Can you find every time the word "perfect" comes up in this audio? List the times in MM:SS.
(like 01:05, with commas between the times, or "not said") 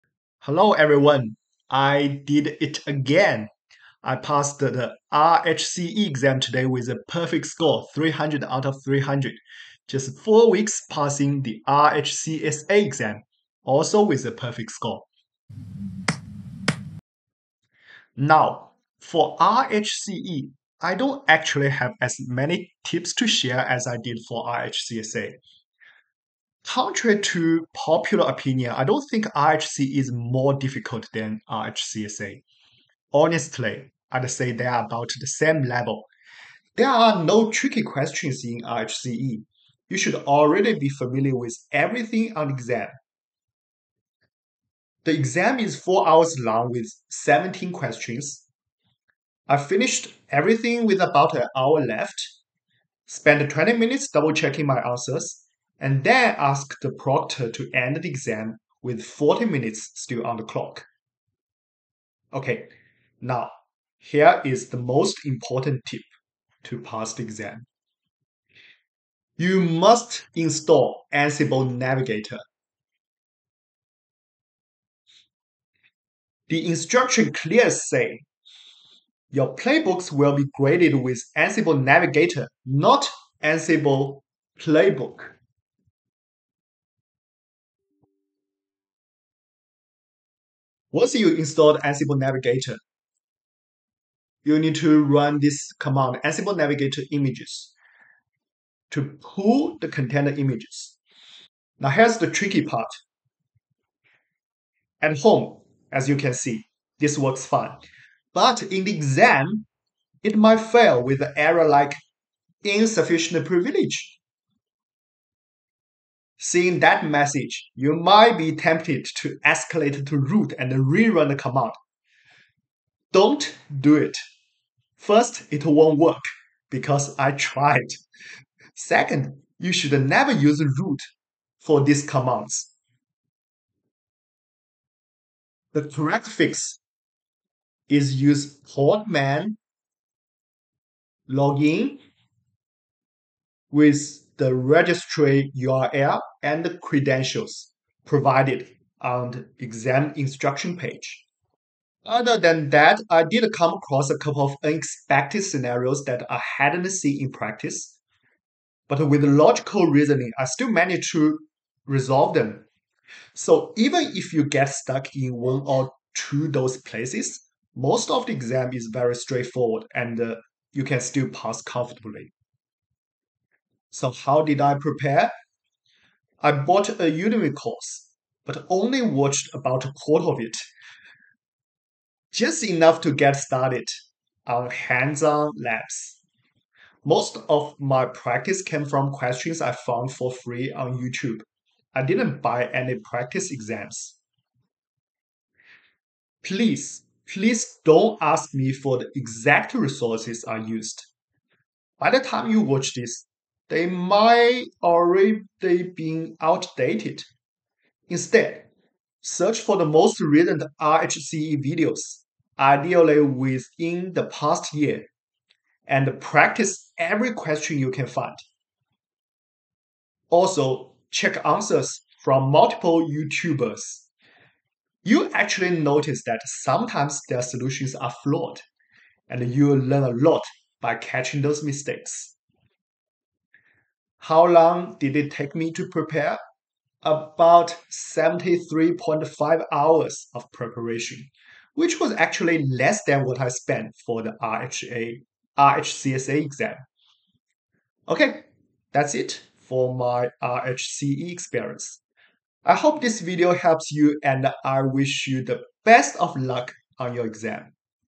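00:07, 00:14.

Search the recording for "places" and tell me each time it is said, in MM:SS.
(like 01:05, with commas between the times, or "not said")
02:46.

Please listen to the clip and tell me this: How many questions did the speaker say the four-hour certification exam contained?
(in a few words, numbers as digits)
17.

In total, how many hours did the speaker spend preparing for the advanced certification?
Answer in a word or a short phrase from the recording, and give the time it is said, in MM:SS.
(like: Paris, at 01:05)
73.5, at 03:57.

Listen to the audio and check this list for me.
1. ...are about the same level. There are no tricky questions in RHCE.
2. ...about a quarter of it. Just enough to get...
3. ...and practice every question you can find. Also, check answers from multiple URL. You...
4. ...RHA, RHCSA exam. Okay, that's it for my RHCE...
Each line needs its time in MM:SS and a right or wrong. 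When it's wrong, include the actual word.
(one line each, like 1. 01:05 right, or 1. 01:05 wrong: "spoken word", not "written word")
1. 00:34 right
2. 02:59 right
3. 03:35 wrong: "YouTubers", not "URL"
4. 04:04 right.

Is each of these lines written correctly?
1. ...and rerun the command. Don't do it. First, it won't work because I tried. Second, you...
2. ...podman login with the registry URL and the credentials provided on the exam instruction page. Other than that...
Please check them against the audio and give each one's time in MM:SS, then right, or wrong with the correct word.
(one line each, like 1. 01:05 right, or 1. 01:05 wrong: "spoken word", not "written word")
1. 02:00 right
2. 02:18 right.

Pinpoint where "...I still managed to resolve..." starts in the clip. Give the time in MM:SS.
02:40.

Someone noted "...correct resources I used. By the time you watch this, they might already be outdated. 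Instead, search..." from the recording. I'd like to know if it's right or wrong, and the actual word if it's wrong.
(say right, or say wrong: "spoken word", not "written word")
wrong: "exact", not "correct".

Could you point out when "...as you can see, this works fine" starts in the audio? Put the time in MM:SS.
01:45.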